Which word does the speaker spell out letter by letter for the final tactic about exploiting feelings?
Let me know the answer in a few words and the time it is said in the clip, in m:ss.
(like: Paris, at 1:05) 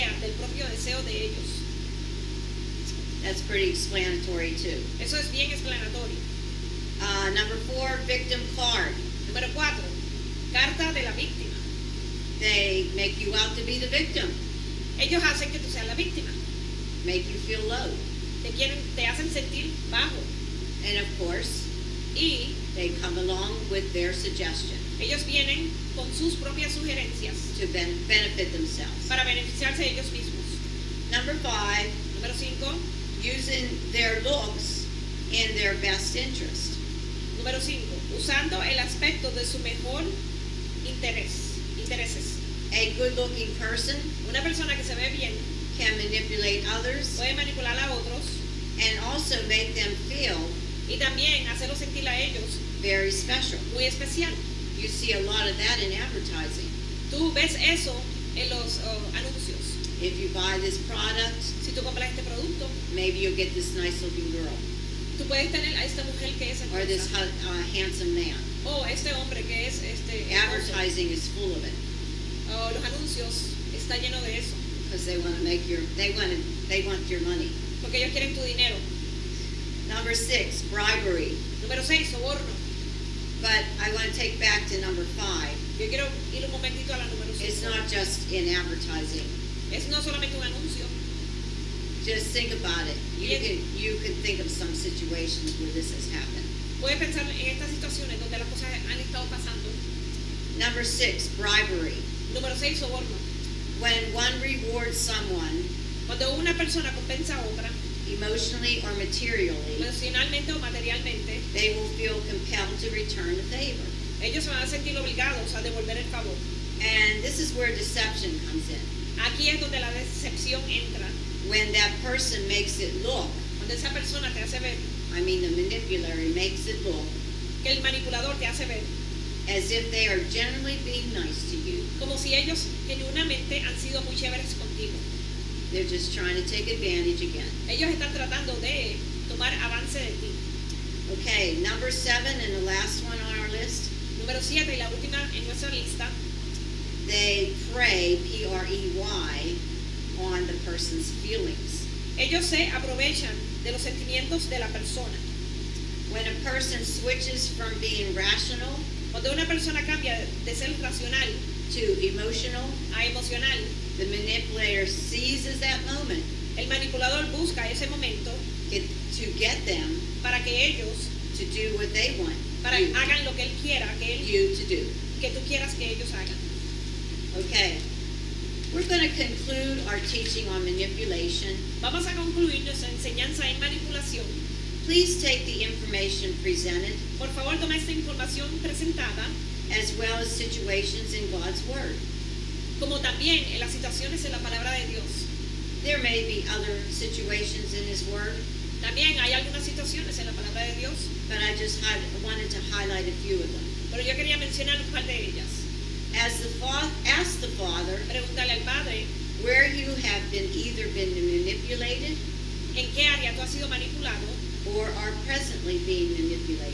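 Prey, at 2:28.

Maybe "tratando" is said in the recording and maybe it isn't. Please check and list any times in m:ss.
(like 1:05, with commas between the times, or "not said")
2:18.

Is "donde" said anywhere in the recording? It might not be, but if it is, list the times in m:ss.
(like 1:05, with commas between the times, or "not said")
1:38, 1:59.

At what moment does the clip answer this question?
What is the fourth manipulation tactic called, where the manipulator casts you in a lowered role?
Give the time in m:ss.
0:08.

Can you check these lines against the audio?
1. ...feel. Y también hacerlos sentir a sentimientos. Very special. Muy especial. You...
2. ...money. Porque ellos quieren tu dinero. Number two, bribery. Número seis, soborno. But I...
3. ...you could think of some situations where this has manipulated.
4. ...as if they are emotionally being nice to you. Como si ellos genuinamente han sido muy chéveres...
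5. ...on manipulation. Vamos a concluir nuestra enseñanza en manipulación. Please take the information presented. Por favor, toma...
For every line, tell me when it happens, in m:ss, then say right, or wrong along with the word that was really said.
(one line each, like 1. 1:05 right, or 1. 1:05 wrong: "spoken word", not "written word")
1. 0:50 wrong: "ellos", not "sentimientos"
2. 1:17 wrong: "six", not "two"
3. 1:33 wrong: "happened", not "manipulated"
4. 2:09 wrong: "generally", not "emotionally"
5. 3:00 right.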